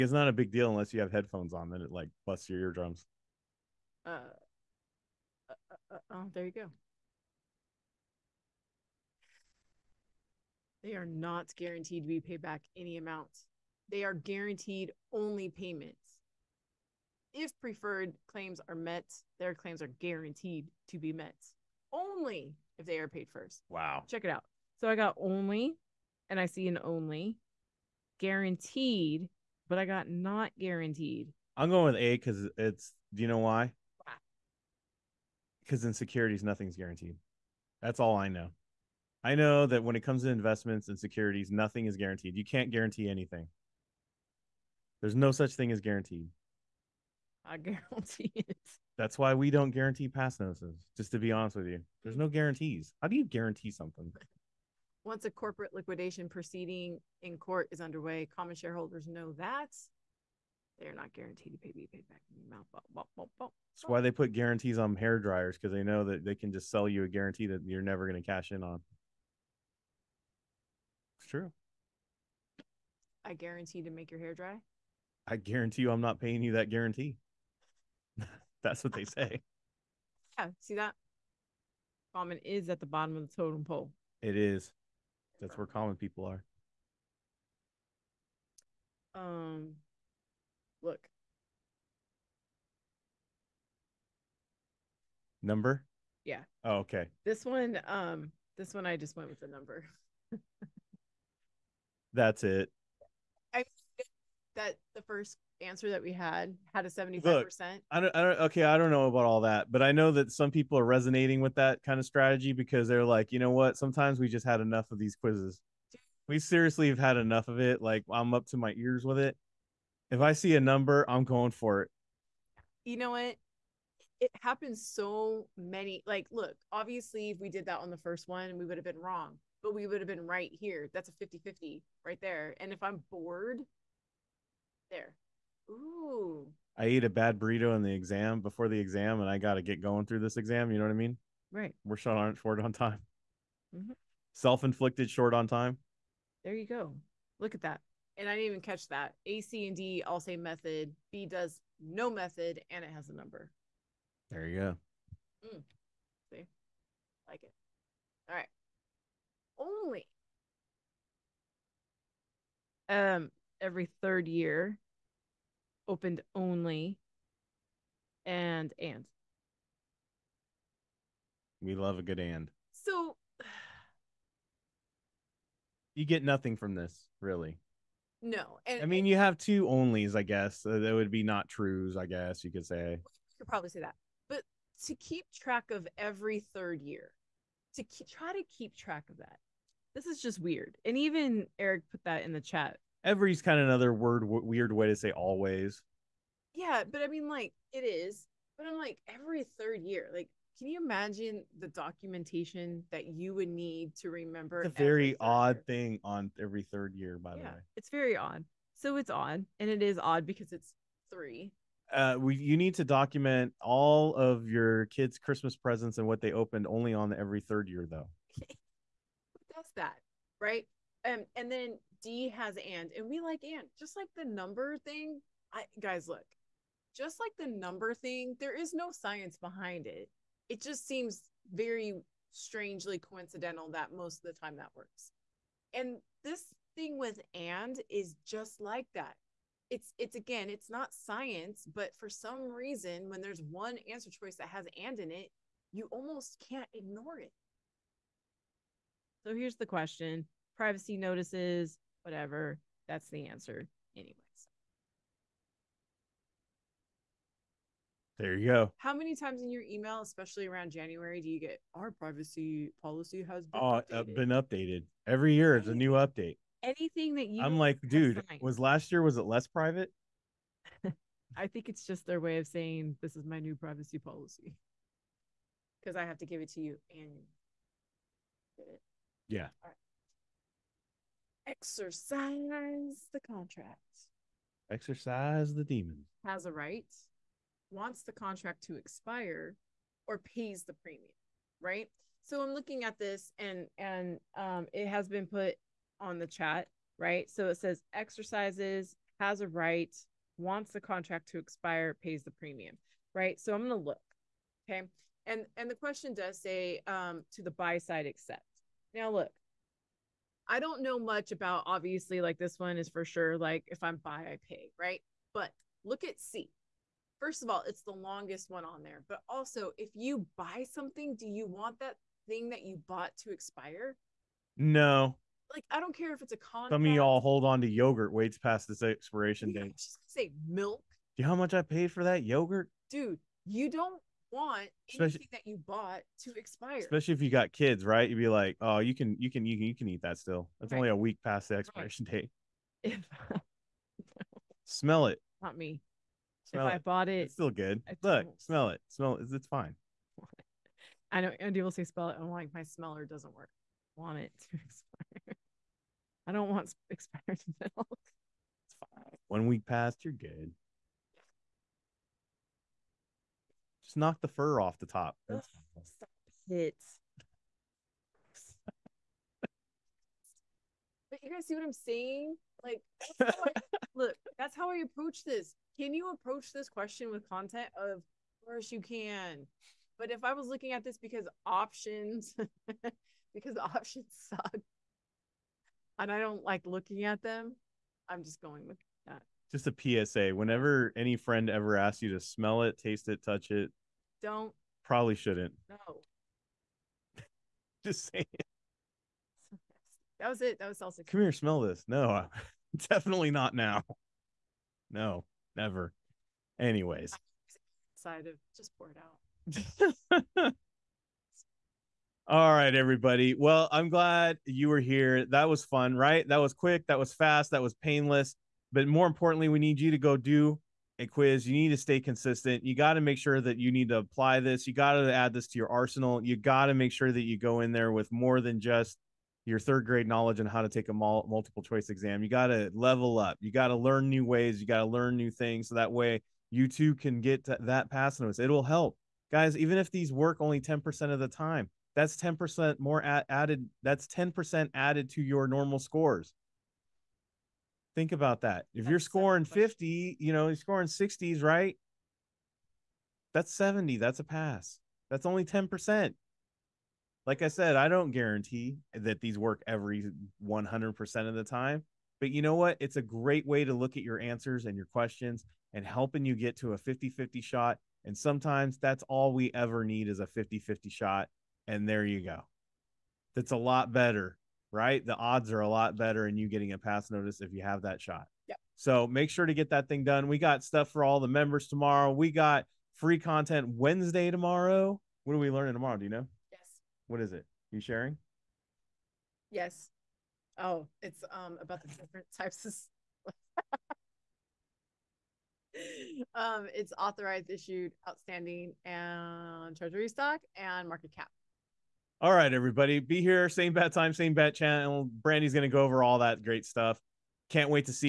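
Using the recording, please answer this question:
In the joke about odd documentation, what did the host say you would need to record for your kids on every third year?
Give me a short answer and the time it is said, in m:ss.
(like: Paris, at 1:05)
Christmas presents, at 3:35.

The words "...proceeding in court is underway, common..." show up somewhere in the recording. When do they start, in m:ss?
0:56.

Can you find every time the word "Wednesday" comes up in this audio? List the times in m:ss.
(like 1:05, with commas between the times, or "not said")
8:03.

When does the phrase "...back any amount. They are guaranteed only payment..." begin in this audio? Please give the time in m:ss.
0:12.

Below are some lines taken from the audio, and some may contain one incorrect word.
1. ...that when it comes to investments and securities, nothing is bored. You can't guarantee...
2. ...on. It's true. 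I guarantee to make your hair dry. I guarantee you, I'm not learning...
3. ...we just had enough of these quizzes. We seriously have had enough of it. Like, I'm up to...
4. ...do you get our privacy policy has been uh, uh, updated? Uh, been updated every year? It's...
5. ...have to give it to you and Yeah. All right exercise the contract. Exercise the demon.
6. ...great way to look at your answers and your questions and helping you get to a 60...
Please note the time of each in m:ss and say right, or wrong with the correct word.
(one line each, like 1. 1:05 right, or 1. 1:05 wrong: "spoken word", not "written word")
1. 0:39 wrong: "guaranteed", not "bored"
2. 1:08 wrong: "paying", not "learning"
3. 1:54 right
4. 4:21 right
5. 4:36 right
6. 7:43 wrong: "50", not "60".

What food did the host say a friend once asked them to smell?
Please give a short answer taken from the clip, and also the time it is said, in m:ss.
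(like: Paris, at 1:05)
salsa, at 6:40.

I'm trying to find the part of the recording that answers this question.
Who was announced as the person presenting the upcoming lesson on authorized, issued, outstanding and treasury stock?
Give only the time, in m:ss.
8:25.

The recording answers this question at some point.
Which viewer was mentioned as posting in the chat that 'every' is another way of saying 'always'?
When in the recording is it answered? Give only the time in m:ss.
3:11.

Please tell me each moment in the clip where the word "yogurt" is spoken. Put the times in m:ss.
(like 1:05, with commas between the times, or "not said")
5:27, 5:32.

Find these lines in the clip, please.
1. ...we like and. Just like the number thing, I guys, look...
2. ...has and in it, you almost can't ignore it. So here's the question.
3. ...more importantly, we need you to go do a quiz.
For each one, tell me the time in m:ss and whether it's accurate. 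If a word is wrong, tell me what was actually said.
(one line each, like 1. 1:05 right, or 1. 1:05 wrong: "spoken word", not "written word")
1. 3:43 right
2. 4:04 right
3. 6:58 right.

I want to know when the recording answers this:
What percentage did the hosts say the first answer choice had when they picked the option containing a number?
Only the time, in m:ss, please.
1:46.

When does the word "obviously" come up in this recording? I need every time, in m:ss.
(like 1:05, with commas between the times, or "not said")
2:06, 5:11.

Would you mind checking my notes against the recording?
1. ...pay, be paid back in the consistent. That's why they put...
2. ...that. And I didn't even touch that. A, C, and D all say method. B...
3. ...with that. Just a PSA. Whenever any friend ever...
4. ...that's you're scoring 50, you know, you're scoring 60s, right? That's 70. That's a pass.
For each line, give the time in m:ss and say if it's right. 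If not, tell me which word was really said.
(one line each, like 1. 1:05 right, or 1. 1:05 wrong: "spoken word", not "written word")
1. 1:01 wrong: "amount", not "consistent"
2. 2:27 wrong: "catch", not "touch"
3. 6:28 right
4. 7:28 right.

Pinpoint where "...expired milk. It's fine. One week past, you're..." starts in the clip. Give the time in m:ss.
5:56.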